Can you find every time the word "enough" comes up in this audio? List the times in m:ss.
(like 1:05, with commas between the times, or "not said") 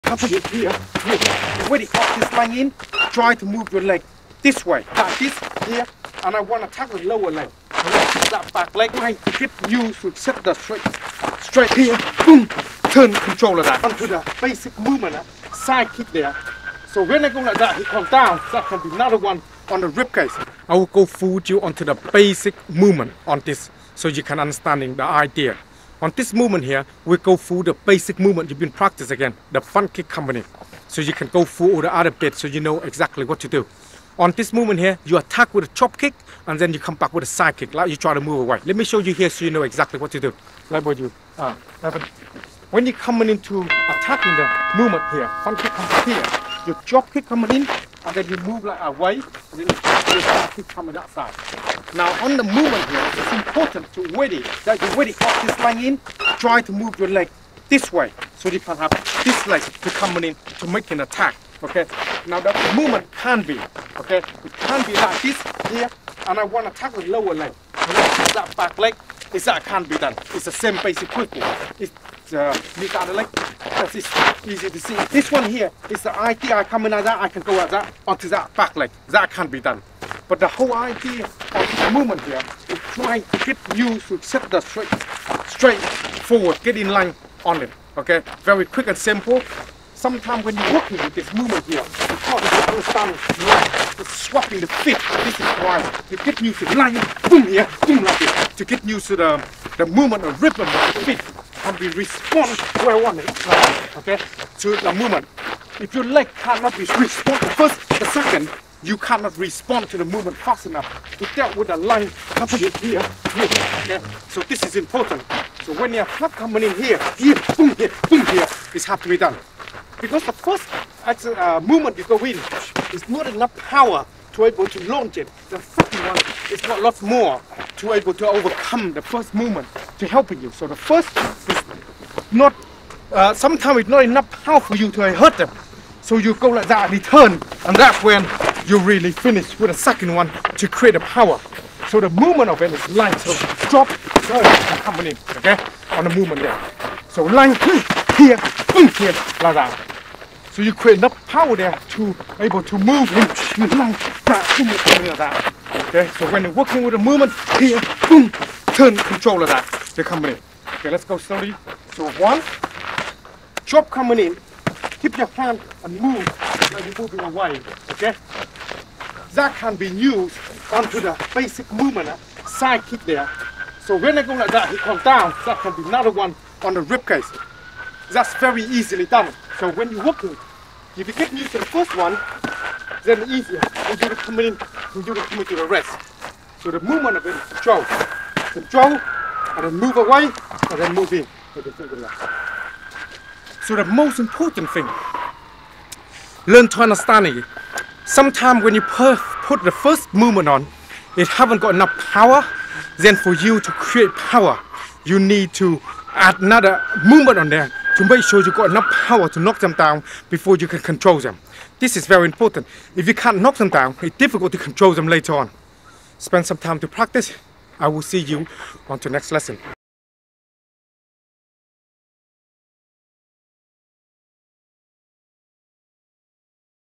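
1:50, 2:03, 2:14, 2:30, 3:21, 3:28.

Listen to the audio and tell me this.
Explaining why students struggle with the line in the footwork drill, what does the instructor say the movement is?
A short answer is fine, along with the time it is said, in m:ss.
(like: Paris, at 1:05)
Swapping the feet, at 1:34.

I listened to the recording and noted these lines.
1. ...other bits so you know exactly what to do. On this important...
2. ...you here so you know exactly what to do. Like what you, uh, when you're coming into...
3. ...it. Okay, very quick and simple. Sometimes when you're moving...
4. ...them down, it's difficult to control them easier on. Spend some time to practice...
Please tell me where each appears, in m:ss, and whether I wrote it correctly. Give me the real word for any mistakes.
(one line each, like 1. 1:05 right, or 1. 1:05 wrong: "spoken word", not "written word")
1. 0:31 wrong: "movement", not "important"
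2. 0:38 right
3. 1:27 wrong: "working", not "moving"
4. 3:33 wrong: "later", not "easier".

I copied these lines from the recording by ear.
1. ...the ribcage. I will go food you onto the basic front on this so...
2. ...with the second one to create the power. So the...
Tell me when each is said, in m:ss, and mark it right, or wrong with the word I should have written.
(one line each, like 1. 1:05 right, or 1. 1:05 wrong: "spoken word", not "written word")
1. 0:19 wrong: "movement", not "front"
2. 2:19 right.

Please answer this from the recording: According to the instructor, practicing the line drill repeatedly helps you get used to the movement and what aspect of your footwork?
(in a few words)
Rhythm of the feet.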